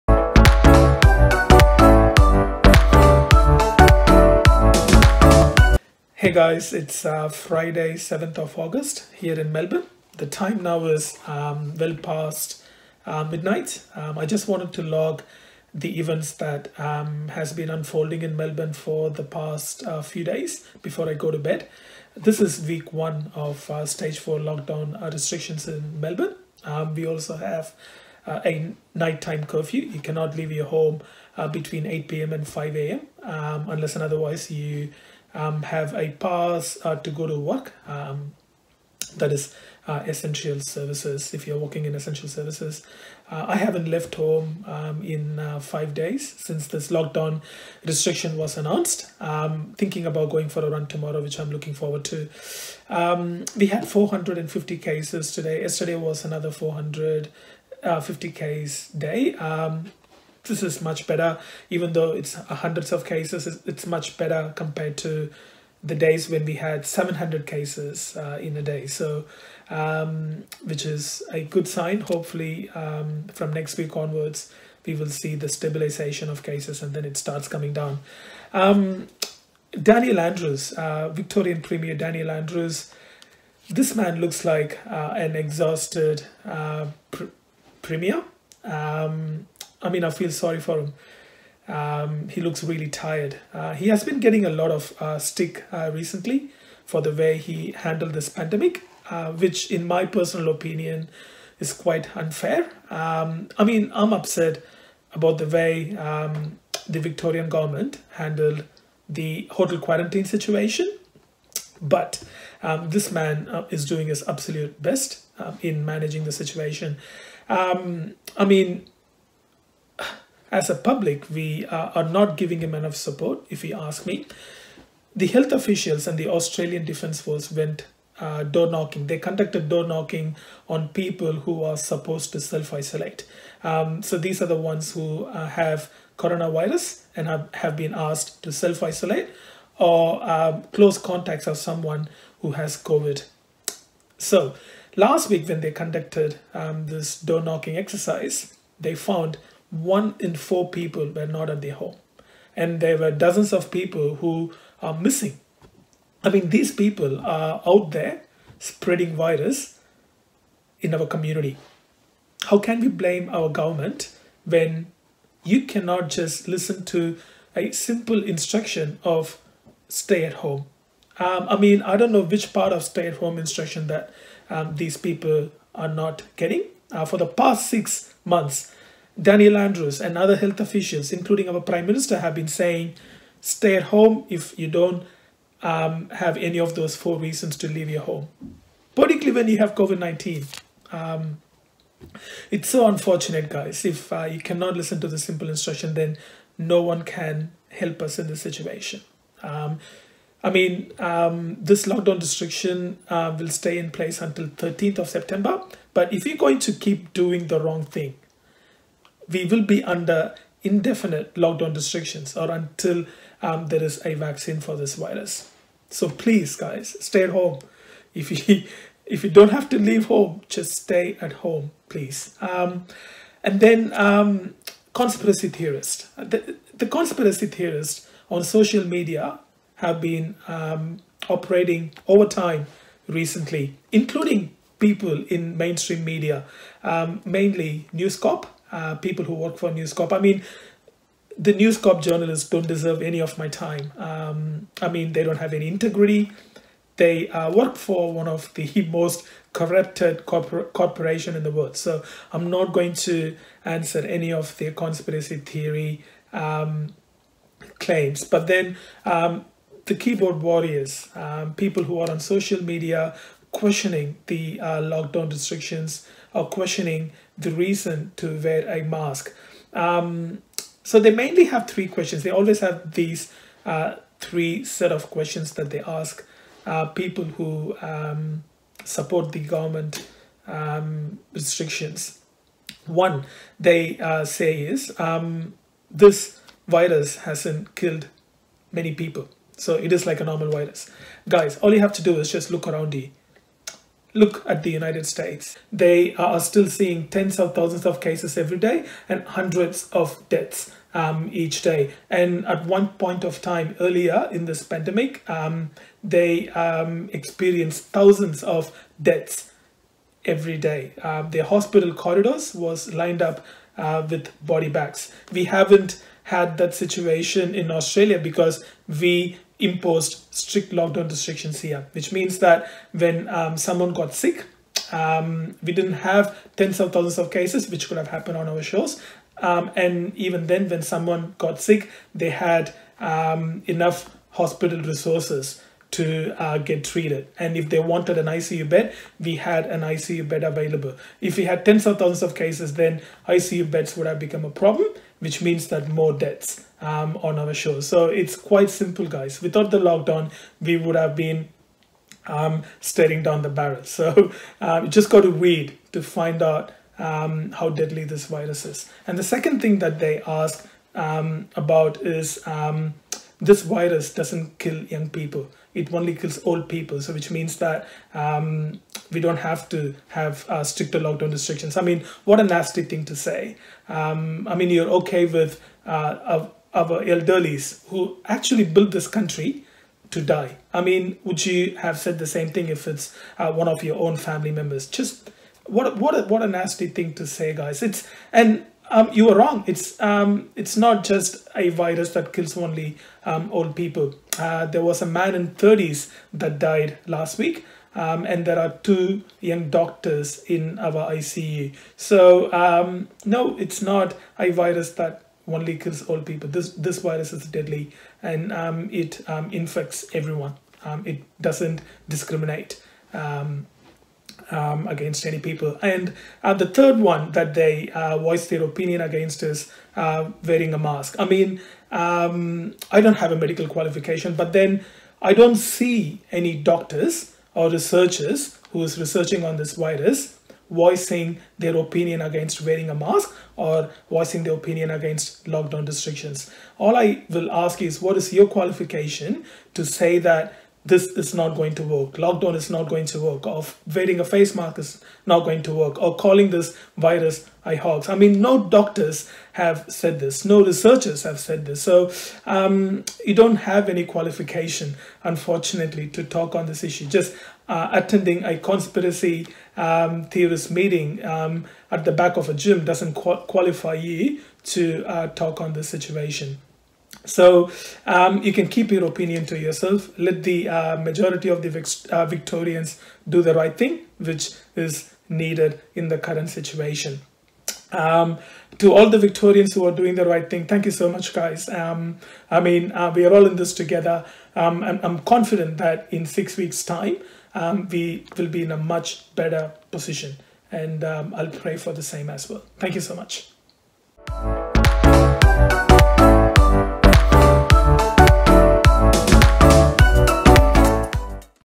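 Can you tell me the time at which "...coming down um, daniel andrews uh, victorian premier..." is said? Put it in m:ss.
1:17.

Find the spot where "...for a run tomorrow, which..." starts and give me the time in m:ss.
0:50.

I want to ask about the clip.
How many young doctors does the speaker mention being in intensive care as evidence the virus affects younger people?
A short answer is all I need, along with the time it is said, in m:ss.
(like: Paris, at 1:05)
2, at 6:38.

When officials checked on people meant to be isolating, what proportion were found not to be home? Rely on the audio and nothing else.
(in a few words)
1 in 4.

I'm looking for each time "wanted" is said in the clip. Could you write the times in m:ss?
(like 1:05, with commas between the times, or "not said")
0:14, 5:37.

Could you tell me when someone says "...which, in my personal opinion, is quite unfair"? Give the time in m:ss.
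1:39.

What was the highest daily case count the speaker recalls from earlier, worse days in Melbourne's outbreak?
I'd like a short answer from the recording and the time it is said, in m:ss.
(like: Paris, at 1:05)
700, at 1:06.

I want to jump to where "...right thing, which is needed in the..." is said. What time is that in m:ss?
7:53.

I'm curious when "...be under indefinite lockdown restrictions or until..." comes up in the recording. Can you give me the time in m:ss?
3:29.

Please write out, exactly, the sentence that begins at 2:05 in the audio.
The health officials and the Australian Defence Force went uh, door knocking.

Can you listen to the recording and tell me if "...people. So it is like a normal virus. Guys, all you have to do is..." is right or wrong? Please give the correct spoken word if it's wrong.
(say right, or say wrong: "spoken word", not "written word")
right.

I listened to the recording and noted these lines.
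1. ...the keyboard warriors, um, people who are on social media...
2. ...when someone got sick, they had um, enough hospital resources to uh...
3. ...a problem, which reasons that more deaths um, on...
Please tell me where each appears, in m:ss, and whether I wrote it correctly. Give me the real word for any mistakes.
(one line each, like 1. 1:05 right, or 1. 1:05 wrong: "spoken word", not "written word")
1. 4:19 right
2. 5:30 right
3. 5:44 wrong: "means", not "reasons".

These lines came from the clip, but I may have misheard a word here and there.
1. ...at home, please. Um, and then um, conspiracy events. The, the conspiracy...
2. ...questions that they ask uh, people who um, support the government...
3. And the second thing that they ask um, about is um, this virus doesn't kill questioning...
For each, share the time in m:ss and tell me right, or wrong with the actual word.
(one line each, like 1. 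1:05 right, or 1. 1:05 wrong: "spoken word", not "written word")
1. 3:41 wrong: "theorists", not "events"
2. 4:35 right
3. 5:59 wrong: "young", not "questioning".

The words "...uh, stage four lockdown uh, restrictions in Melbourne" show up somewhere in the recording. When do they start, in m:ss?
0:23.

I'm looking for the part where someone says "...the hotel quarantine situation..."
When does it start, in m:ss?
1:49.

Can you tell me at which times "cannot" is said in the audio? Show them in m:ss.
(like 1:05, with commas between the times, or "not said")
0:29, 2:45, 3:14.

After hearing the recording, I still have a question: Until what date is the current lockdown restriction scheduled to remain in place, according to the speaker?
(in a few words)
13th of September.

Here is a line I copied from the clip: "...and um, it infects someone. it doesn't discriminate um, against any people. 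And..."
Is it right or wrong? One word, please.
wrong.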